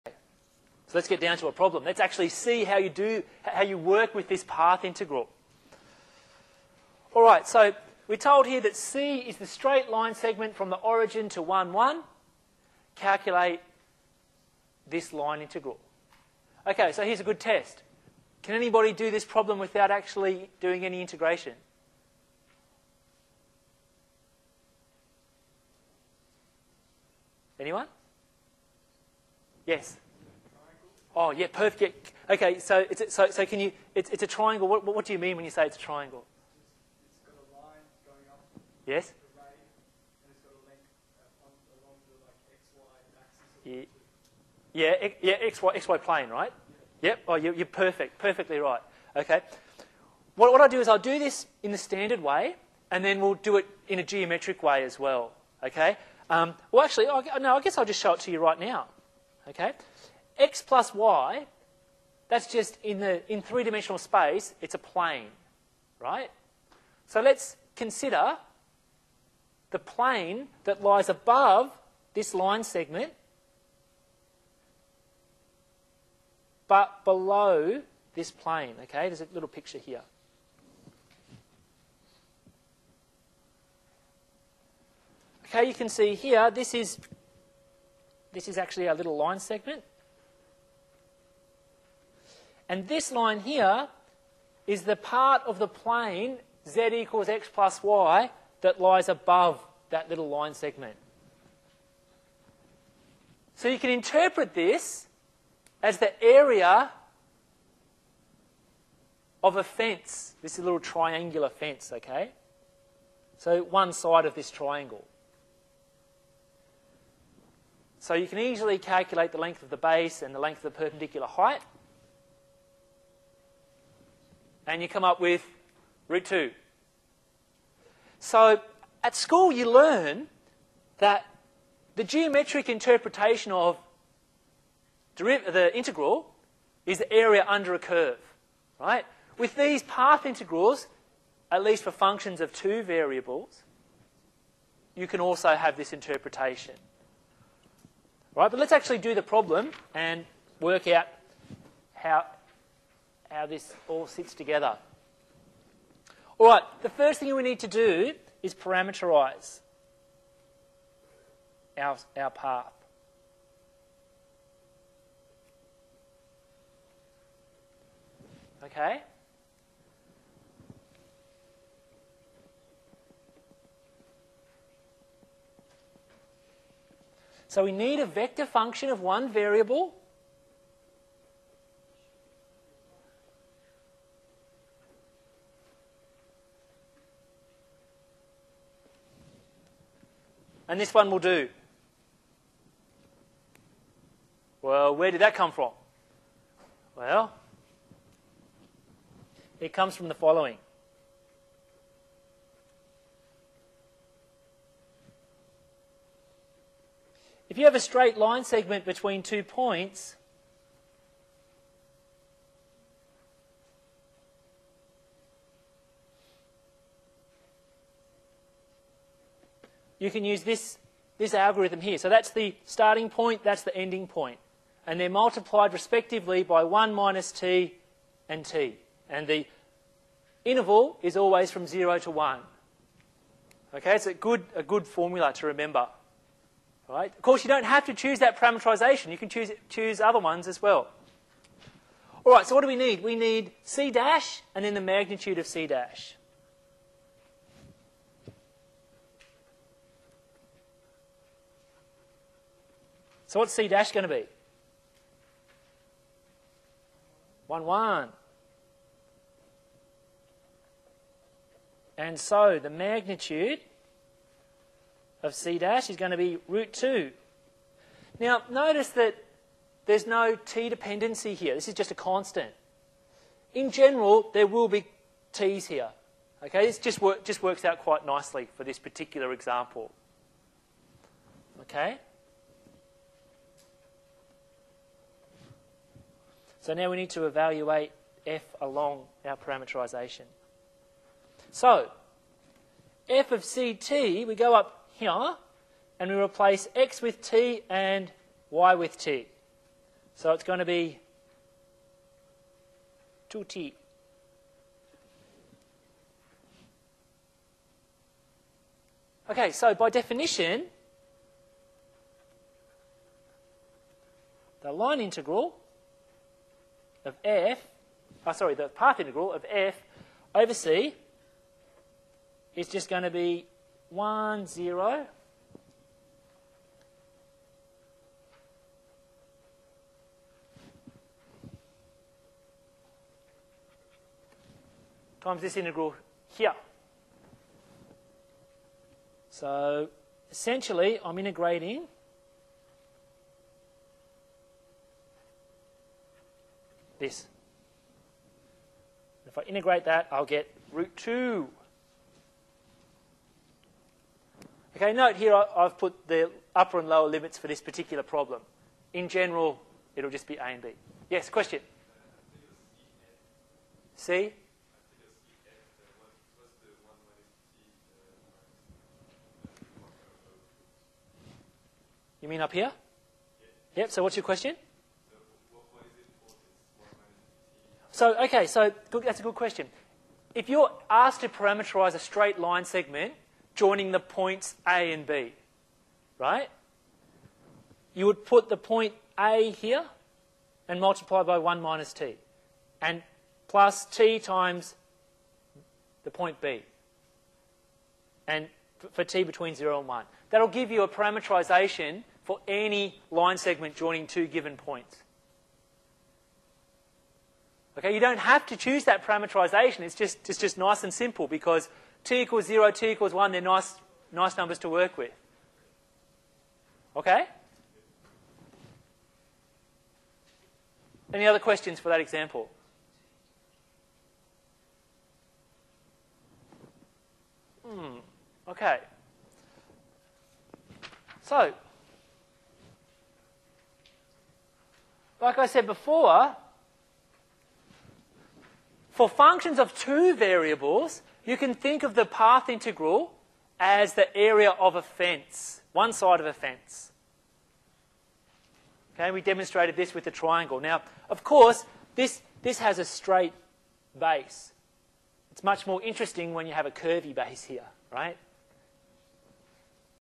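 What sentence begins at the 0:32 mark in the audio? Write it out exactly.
Okay, so, it's, so, so can you, it's, it's a triangle.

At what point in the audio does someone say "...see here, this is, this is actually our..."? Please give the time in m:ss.
1:25.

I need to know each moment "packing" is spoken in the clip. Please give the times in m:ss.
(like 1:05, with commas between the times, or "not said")
not said.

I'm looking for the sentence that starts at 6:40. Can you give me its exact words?
That'll give you a parameterization for any line segment joining two given points.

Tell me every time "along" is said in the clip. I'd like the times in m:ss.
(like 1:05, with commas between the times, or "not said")
4:48.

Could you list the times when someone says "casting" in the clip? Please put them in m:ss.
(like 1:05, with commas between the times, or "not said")
not said.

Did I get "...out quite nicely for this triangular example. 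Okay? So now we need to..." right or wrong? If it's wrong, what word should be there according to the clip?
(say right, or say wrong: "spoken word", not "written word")
wrong: "particular", not "triangular".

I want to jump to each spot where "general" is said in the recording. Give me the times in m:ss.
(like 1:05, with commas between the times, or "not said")
4:33, 5:59.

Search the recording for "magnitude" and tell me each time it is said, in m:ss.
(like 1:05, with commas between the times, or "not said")
4:04, 4:22.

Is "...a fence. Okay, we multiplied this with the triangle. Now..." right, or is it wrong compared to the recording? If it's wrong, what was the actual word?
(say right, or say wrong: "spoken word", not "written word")
wrong: "demonstrated", not "multiplied".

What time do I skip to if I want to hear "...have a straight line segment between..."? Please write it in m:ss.
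3:27.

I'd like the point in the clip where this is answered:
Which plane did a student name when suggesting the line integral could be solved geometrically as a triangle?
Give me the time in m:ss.
0:45.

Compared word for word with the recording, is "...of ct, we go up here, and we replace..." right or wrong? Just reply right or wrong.
right.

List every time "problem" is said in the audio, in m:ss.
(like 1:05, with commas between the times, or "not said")
0:01, 0:19, 2:29, 5:58.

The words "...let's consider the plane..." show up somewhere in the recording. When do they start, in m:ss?
1:07.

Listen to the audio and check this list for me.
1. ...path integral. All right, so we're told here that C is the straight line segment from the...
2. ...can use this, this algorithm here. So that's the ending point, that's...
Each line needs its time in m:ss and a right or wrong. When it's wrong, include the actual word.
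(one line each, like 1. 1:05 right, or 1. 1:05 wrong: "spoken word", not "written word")
1. 0:04 right
2. 3:40 wrong: "starting", not "ending".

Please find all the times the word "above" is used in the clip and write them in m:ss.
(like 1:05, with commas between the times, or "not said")
1:11, 1:39.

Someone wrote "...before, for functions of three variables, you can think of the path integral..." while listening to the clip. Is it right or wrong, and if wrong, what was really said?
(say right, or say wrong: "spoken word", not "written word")
wrong: "two", not "three".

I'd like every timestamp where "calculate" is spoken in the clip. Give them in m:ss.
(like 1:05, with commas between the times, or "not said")
0:12, 1:58.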